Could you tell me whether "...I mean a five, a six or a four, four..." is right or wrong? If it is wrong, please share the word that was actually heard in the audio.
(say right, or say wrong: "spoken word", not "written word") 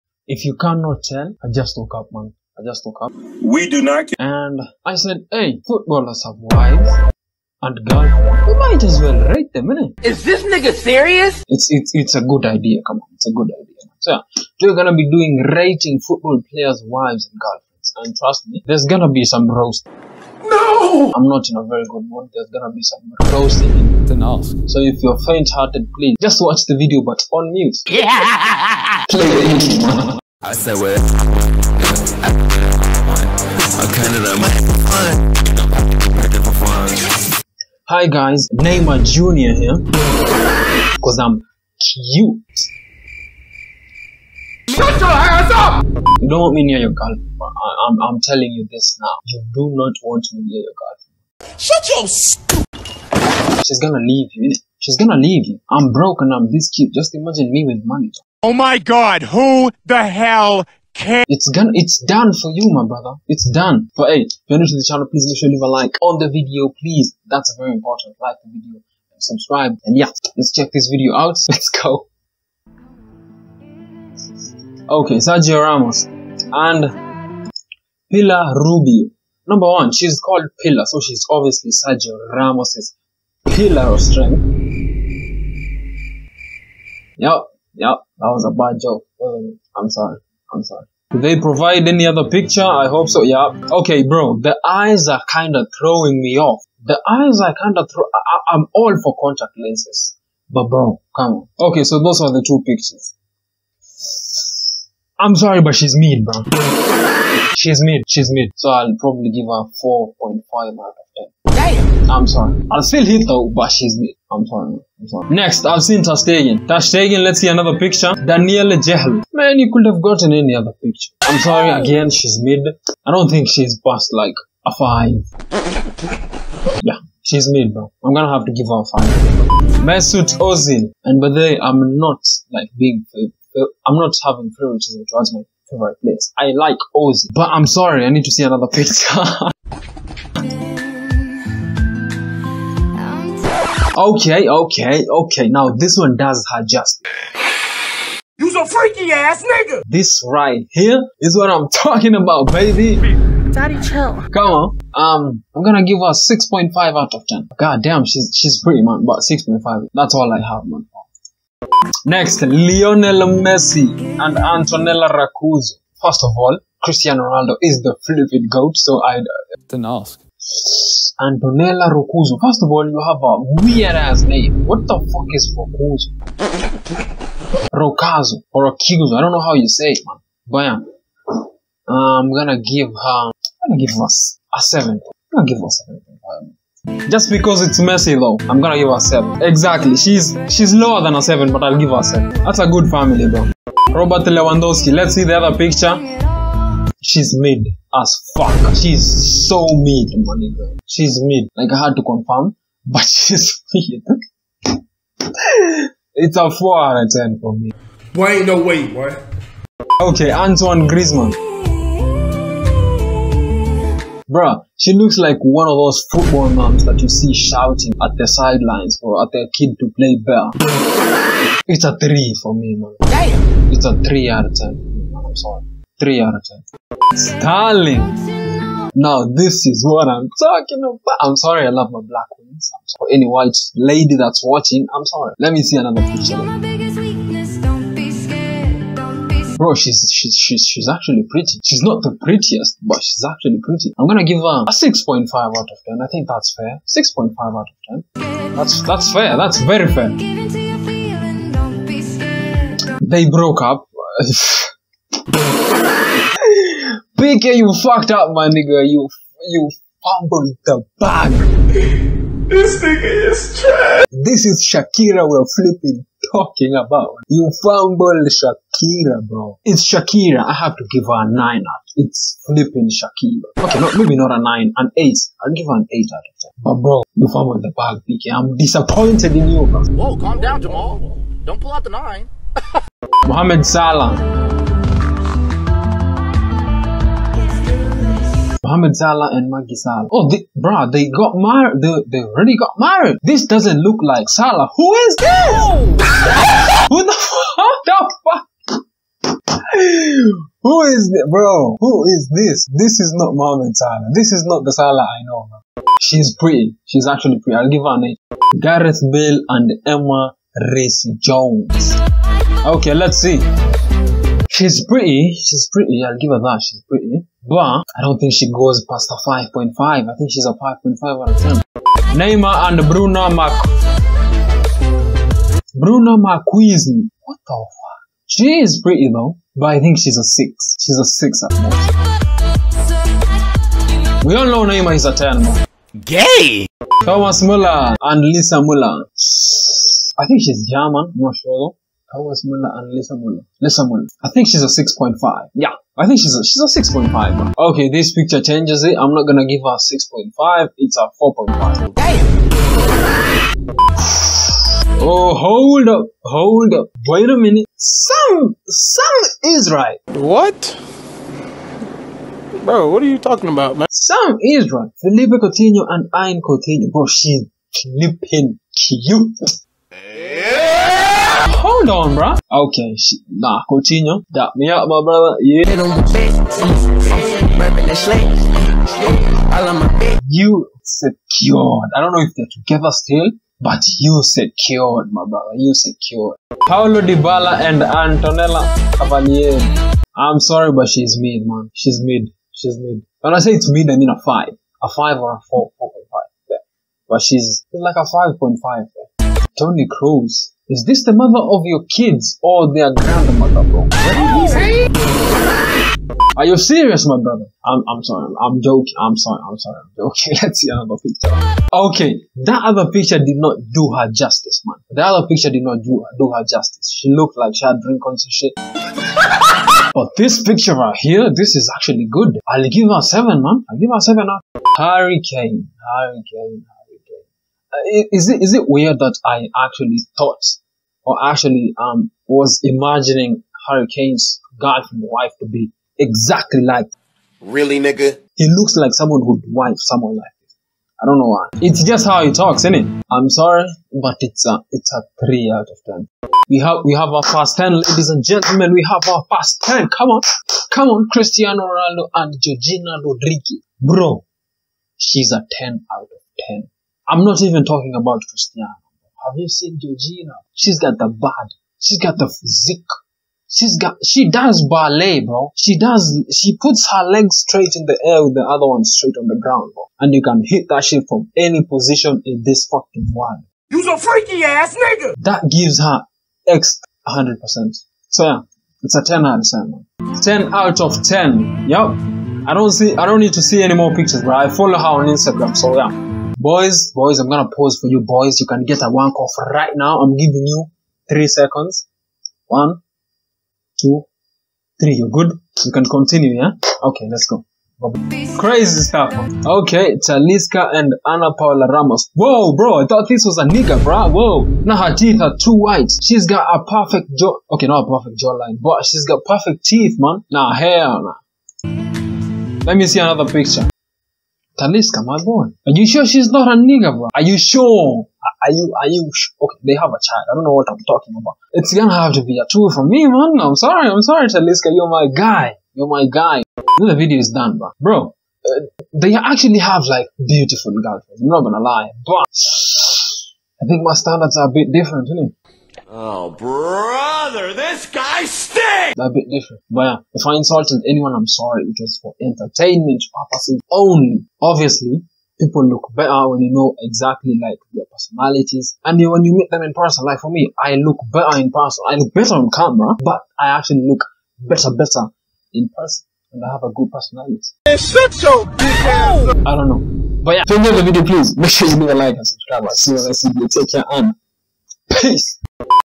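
wrong: "five", not "six".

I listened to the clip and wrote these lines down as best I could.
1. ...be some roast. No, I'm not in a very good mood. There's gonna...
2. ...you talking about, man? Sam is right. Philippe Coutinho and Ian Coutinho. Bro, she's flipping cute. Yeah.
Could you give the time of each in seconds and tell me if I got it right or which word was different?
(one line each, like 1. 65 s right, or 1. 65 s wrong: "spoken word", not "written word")
1. 19 s right
2. 363 s right.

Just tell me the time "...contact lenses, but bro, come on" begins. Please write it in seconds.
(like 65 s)
99 s.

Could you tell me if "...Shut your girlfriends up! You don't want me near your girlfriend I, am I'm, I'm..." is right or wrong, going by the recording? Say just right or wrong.
wrong.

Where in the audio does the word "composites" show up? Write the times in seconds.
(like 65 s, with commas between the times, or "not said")
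not said.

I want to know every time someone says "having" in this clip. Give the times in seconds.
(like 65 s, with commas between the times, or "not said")
134 s.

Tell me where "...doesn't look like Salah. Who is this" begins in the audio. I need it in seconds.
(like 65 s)
293 s.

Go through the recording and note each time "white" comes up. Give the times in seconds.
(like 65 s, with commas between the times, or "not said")
233 s, 505 s.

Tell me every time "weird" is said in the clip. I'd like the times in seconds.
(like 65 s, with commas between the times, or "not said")
173 s, 428 s.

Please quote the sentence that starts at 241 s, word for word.
She's not the prettiest, but she's actually pretty.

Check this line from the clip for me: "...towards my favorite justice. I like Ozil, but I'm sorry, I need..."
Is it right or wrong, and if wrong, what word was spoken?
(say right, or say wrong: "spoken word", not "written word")
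wrong: "place", not "justice".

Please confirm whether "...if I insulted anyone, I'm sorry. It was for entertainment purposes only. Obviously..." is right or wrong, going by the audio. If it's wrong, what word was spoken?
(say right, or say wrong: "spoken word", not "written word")
right.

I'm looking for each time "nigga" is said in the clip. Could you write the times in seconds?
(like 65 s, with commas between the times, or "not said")
10 s, 149 s, 258 s, 262 s, 437 s, 474 s, 503 s, 516 s.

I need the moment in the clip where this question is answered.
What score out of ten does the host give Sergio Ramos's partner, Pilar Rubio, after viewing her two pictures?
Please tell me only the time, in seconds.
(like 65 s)
109 s.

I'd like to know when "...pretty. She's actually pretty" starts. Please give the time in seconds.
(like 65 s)
306 s.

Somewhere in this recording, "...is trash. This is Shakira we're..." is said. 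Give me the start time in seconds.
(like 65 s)
263 s.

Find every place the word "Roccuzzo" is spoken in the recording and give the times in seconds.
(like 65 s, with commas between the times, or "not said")
165 s, 171 s, 177 s.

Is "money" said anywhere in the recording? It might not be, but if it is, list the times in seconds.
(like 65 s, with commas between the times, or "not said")
57 s, 200 s.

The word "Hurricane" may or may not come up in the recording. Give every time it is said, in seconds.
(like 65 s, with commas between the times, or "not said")
425 s.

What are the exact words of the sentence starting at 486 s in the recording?
Boys, boys, I'm gonna pause for you, boys.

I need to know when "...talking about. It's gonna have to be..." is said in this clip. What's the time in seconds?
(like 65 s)
520 s.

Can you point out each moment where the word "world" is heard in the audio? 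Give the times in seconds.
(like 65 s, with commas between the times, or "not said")
473 s.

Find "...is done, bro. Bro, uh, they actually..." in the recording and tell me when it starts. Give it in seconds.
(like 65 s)
527 s.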